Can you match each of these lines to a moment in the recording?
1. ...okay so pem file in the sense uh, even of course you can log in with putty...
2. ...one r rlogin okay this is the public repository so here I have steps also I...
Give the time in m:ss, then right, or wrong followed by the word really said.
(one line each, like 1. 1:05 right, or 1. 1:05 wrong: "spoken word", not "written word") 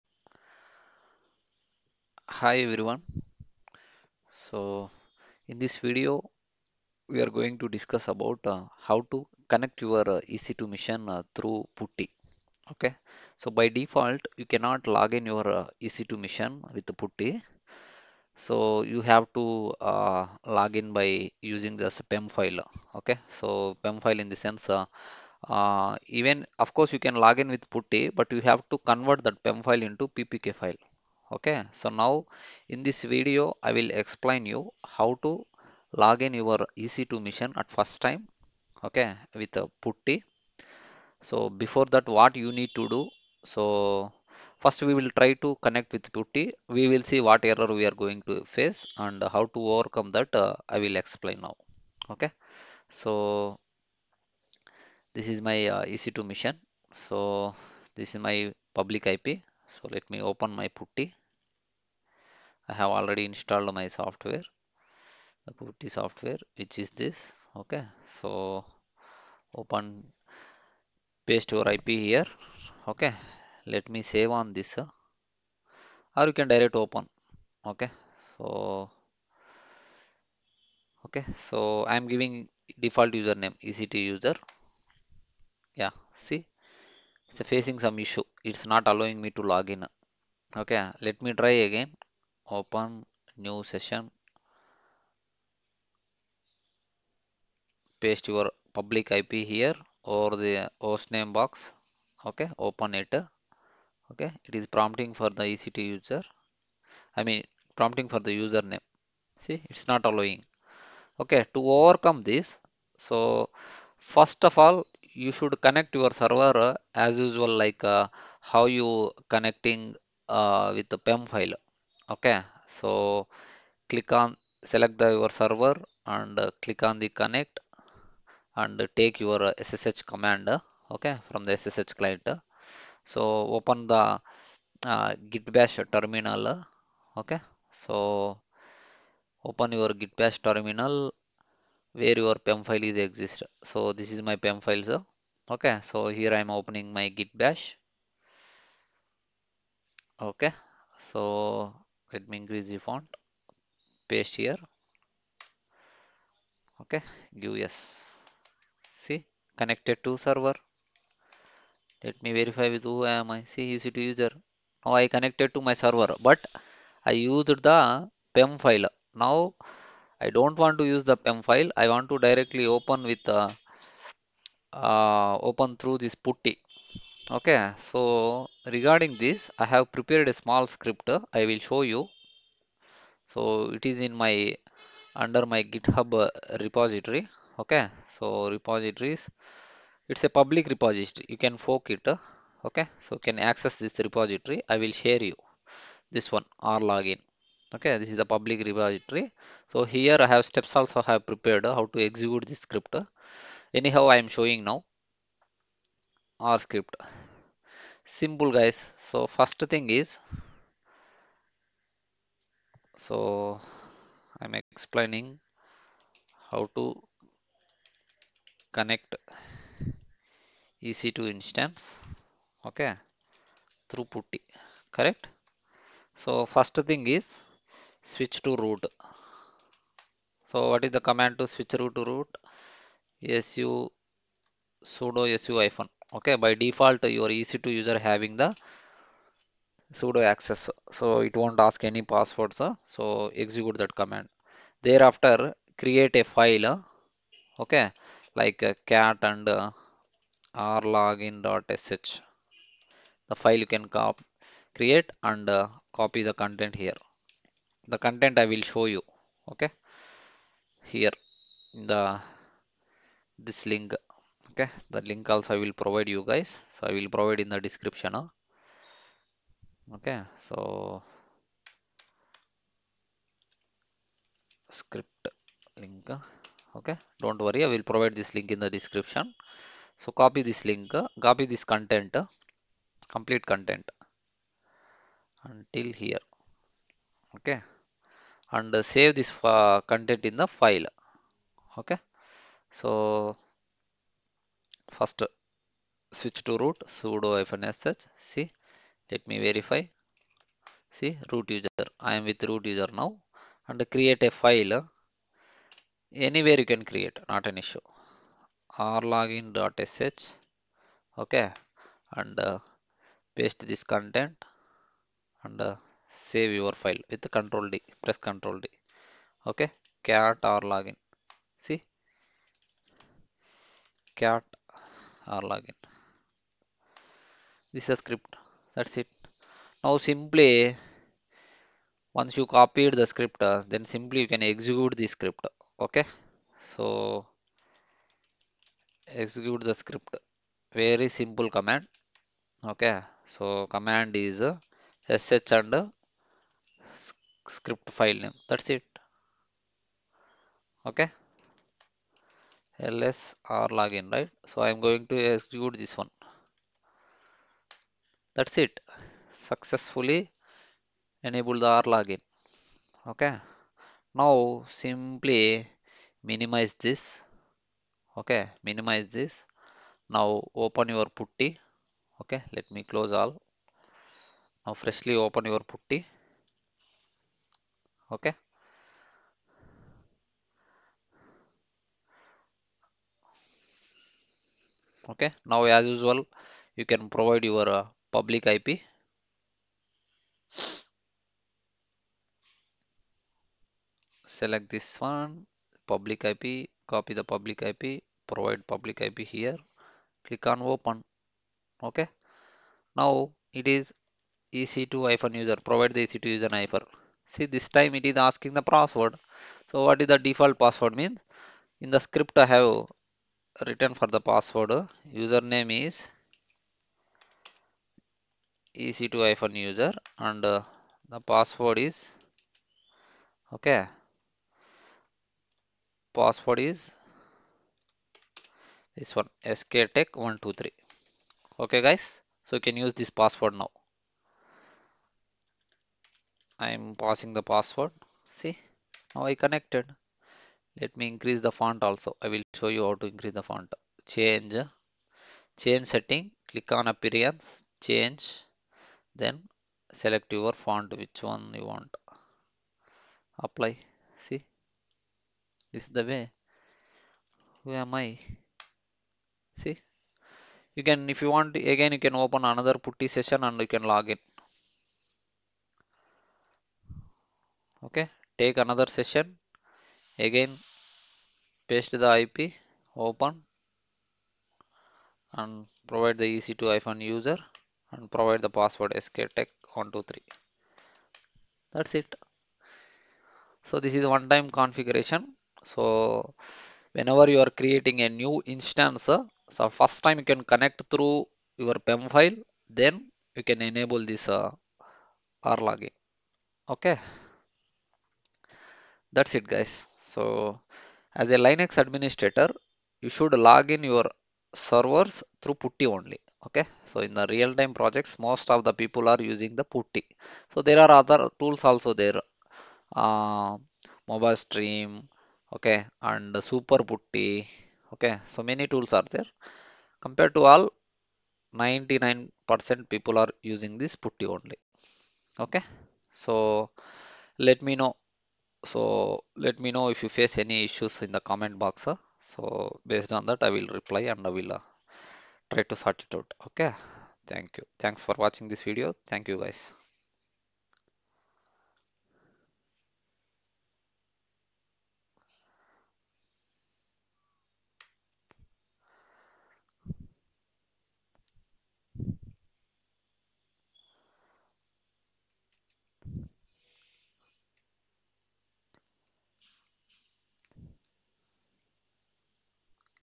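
1. 0:23 right
2. 3:16 wrong: "login", not "rlogin".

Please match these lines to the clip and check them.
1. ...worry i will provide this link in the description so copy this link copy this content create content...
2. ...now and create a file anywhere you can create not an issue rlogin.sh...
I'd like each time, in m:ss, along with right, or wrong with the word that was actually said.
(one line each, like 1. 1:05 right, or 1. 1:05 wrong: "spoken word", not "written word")
1. 4:37 wrong: "complete", not "create"
2. 5:03 right.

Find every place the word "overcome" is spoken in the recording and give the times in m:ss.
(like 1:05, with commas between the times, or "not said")
0:49, 1:51.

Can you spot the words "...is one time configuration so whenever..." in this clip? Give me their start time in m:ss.
8:03.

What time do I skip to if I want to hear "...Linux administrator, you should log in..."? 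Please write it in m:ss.
8:21.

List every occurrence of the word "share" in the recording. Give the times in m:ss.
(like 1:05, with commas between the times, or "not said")
3:14.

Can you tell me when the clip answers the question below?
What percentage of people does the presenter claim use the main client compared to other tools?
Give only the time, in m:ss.
8:41.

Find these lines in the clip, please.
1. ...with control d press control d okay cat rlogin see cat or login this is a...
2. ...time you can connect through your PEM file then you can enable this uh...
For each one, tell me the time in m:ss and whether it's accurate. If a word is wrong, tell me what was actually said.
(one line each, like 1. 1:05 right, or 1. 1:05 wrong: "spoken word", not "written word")
1. 5:17 right
2. 8:10 right.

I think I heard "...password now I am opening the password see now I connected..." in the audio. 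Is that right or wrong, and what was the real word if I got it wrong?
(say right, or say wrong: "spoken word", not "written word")
wrong: "passing", not "opening".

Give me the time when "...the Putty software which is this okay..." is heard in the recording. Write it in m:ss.
1:05.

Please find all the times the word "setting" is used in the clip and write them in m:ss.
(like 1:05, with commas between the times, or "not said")
7:25.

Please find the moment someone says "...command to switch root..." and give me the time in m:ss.
3:51.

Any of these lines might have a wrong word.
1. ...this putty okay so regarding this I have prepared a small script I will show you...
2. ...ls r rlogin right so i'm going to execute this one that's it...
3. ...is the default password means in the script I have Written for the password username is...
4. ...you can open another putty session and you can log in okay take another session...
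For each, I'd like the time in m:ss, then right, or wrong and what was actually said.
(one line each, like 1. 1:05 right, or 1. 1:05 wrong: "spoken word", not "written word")
1. 2:55 right
2. 5:52 wrong: "login", not "rlogin"
3. 6:50 right
4. 7:41 right.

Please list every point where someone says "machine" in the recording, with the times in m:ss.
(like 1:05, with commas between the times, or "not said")
0:10, 0:16.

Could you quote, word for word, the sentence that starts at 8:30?
So there are other tools also there, uh, MobaXterm, okay, and super putty.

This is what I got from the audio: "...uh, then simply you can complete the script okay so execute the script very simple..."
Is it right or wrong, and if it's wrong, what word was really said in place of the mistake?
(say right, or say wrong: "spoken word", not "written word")
wrong: "execute", not "complete".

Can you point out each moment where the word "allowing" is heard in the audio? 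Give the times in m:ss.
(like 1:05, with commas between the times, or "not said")
1:28, 1:50.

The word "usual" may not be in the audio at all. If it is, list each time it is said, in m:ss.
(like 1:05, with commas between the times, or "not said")
1:57, 6:25.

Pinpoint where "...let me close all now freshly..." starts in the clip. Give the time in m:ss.
6:12.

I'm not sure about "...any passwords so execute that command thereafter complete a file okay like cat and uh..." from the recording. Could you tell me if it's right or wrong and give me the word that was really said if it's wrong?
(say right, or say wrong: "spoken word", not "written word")
wrong: "create", not "complete".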